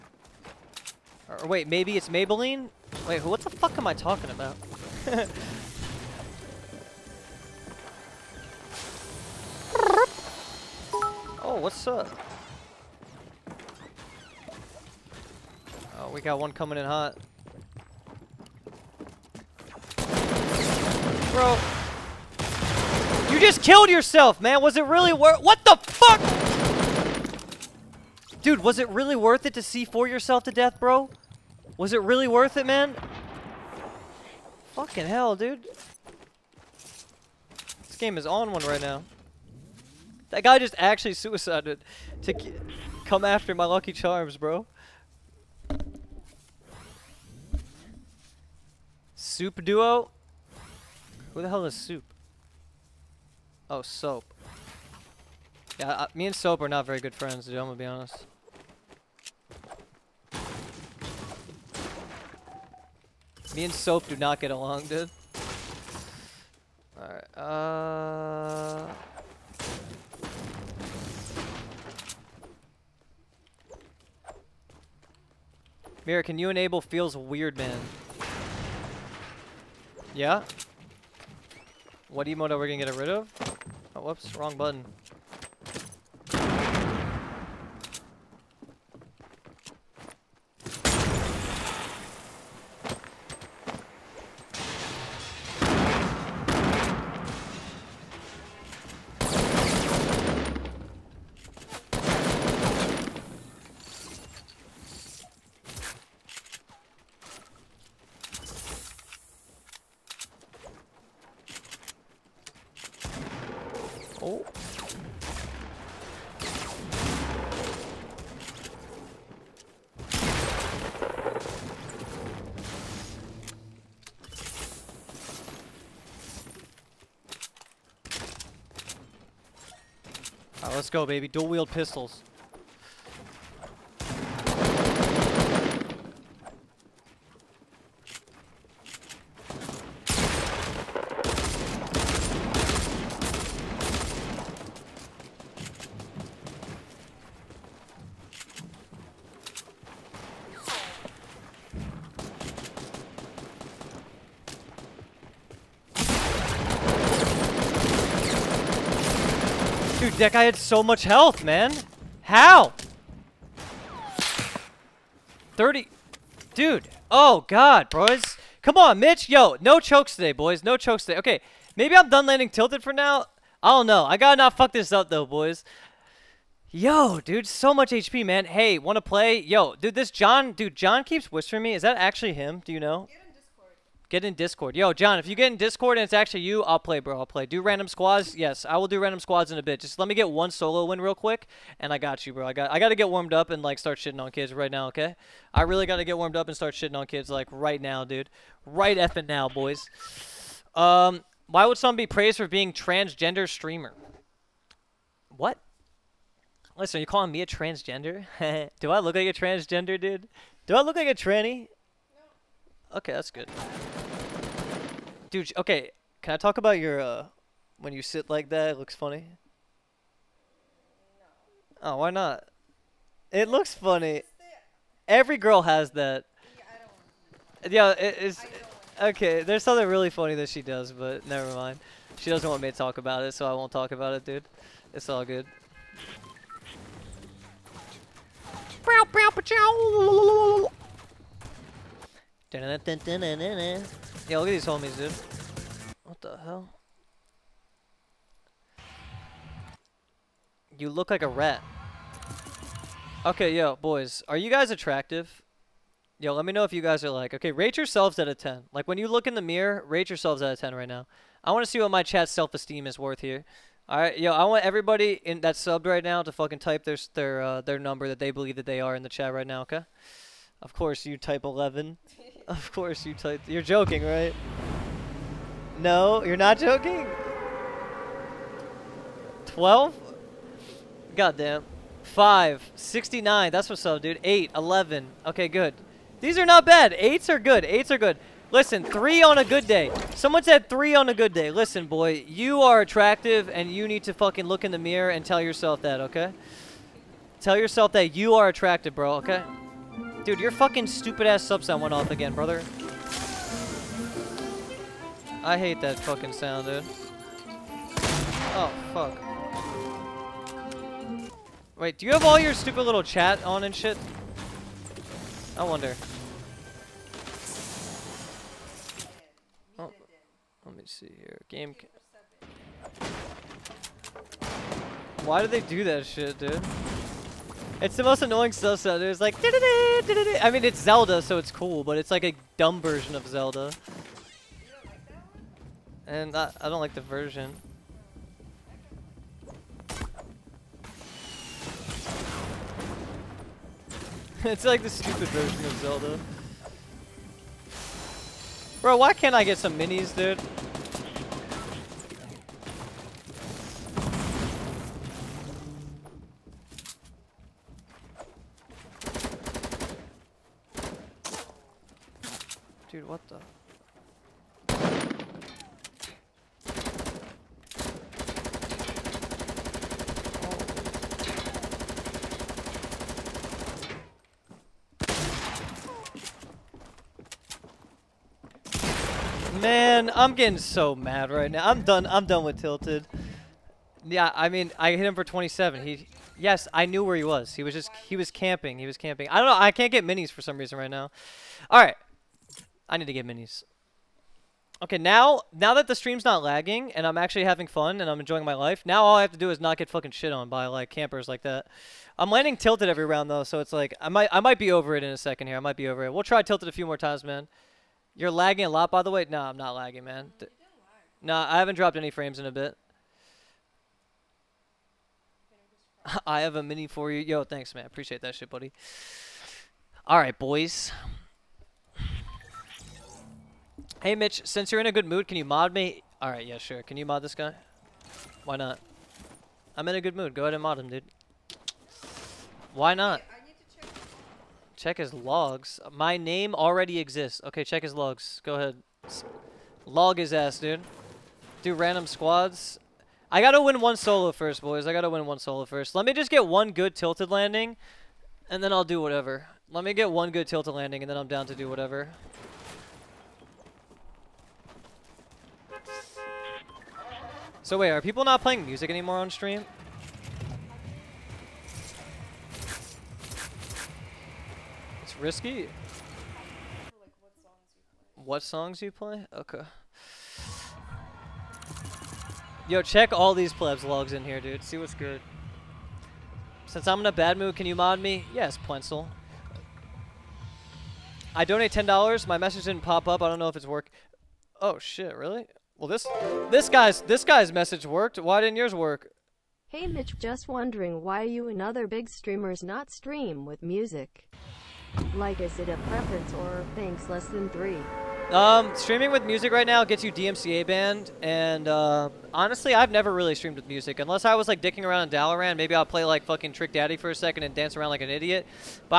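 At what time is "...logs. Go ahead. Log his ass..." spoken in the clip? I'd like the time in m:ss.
7:17.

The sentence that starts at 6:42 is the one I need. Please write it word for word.
I'm landing tilted every round though, so it's like I might I might be over it in a second here.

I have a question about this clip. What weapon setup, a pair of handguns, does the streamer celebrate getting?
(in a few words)
Dual-wield pistols.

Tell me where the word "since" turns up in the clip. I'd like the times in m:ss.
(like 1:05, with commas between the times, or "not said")
7:04, 7:56.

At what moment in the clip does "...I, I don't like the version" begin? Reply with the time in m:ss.
5:36.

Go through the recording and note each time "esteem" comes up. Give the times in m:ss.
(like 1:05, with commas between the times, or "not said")
4:22.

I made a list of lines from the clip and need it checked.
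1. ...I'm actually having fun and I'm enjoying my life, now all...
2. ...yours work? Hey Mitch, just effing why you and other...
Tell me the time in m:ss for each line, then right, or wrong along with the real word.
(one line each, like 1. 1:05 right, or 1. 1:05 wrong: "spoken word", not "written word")
1. 6:37 right
2. 8:08 wrong: "wondering", not "effing".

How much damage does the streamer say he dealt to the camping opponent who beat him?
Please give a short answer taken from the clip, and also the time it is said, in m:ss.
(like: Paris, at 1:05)
27, at 6:25.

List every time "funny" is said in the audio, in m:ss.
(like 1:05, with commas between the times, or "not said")
3:38, 3:43, 3:50.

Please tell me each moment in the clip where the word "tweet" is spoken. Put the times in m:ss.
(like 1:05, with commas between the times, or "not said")
not said.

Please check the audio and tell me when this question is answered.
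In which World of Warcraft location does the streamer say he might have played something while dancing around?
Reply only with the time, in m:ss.
8:25.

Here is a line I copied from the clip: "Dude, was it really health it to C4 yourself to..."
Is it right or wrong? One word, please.
wrong.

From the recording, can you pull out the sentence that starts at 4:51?
Listen, boy, you are attractive and you need to fucking look in the mirror and tell yourself that, okay?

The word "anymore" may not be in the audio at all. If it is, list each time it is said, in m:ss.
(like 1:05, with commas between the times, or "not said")
7:38.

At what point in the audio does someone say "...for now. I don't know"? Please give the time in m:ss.
2:52.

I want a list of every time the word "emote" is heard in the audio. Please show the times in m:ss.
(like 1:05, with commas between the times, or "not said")
1:22.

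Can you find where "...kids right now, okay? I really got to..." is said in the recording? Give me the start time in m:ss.
3:14.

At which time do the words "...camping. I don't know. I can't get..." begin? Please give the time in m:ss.
6:28.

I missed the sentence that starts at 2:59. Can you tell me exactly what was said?
Yo, dude, this John, dude, John keeps whispering me.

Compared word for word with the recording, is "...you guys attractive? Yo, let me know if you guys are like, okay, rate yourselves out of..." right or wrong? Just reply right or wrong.
right.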